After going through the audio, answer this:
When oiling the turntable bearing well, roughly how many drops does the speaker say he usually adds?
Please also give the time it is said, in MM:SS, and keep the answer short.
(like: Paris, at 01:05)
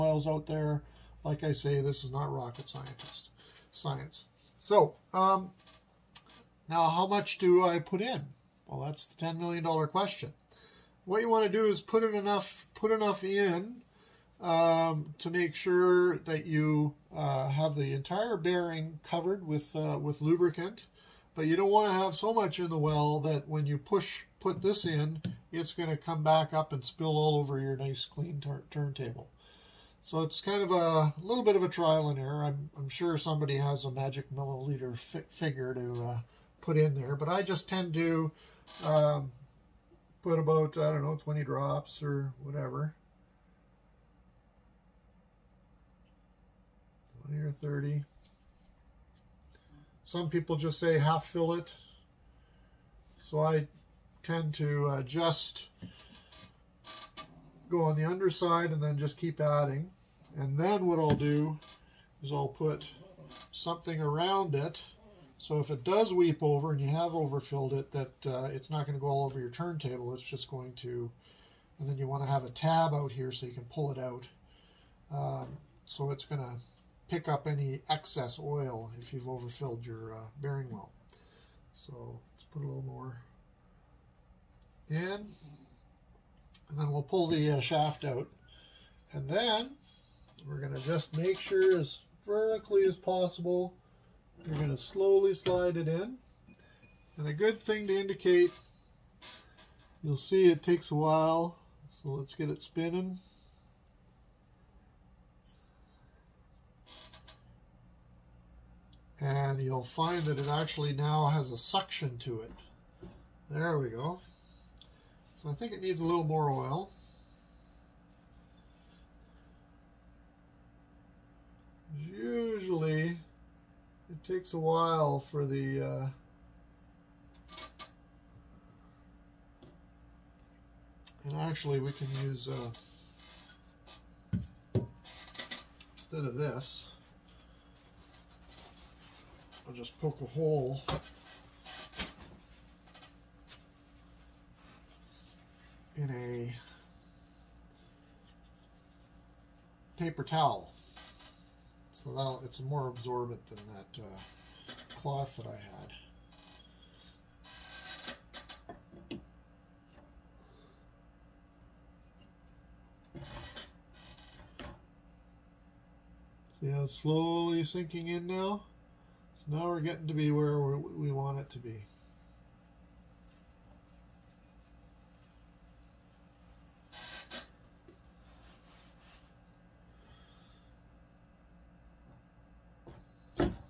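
20, at 00:41.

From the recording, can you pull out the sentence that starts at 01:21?
So let's put a little more in.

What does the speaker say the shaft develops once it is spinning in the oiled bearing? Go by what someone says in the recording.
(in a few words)
suction.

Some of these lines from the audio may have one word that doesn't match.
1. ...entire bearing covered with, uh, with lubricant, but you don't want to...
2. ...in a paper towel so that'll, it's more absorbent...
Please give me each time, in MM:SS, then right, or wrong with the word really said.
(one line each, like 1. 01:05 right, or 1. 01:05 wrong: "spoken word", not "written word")
1. 00:17 right
2. 02:25 right.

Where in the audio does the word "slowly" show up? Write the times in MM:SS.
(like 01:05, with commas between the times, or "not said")
01:34, 02:46.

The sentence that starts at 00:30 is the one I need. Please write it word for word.
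So it's kind of a little bit of a trial and error.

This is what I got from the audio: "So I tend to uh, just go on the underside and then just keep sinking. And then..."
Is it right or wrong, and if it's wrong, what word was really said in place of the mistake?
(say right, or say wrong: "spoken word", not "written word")
wrong: "adding", not "sinking".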